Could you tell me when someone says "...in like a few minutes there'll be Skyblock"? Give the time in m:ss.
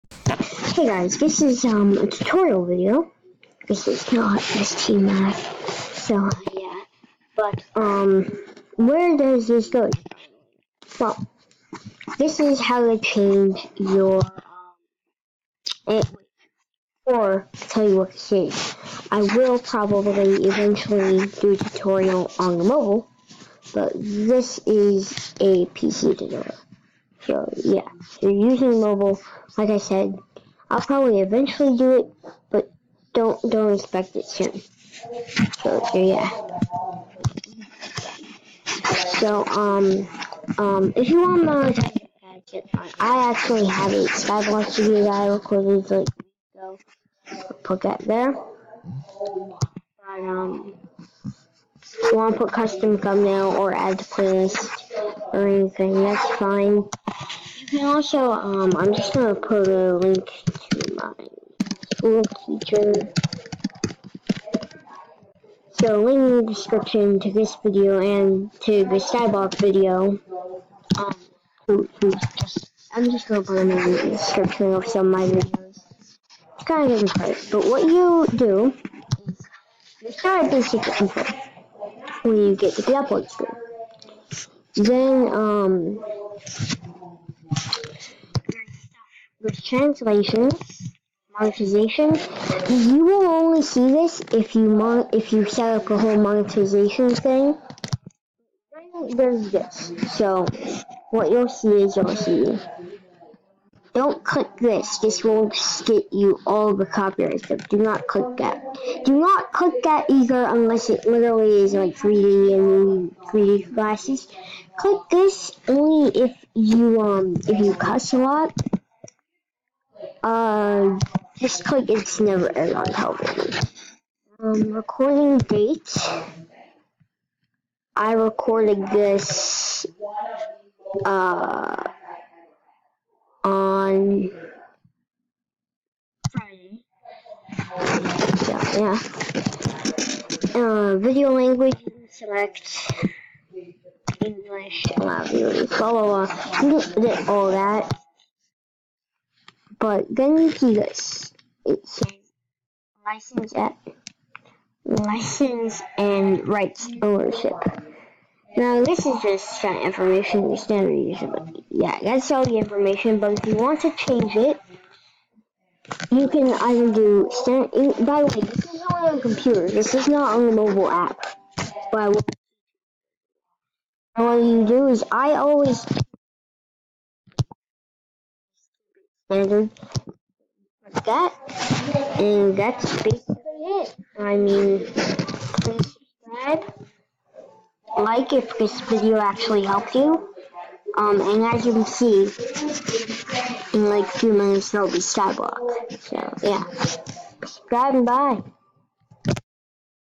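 3:13.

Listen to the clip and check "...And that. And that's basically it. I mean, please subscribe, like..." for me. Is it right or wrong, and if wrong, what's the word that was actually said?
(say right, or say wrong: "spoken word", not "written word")
right.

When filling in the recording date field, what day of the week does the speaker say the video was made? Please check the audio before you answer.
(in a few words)
Friday.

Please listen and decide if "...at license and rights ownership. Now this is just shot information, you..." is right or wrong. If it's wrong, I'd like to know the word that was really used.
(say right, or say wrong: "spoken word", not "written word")
right.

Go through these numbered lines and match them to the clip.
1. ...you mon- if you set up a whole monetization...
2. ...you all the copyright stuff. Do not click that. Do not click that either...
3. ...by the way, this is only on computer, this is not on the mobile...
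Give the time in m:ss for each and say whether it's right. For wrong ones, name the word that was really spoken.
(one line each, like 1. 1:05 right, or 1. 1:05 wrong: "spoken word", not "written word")
1. 1:34 right
2. 1:46 right
3. 2:48 right.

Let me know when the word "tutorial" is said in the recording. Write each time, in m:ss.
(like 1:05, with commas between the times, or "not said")
0:02, 0:21, 0:26.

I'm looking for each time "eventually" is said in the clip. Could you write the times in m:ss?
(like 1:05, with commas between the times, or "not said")
0:20, 0:31.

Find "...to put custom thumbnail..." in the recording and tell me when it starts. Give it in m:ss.
0:52.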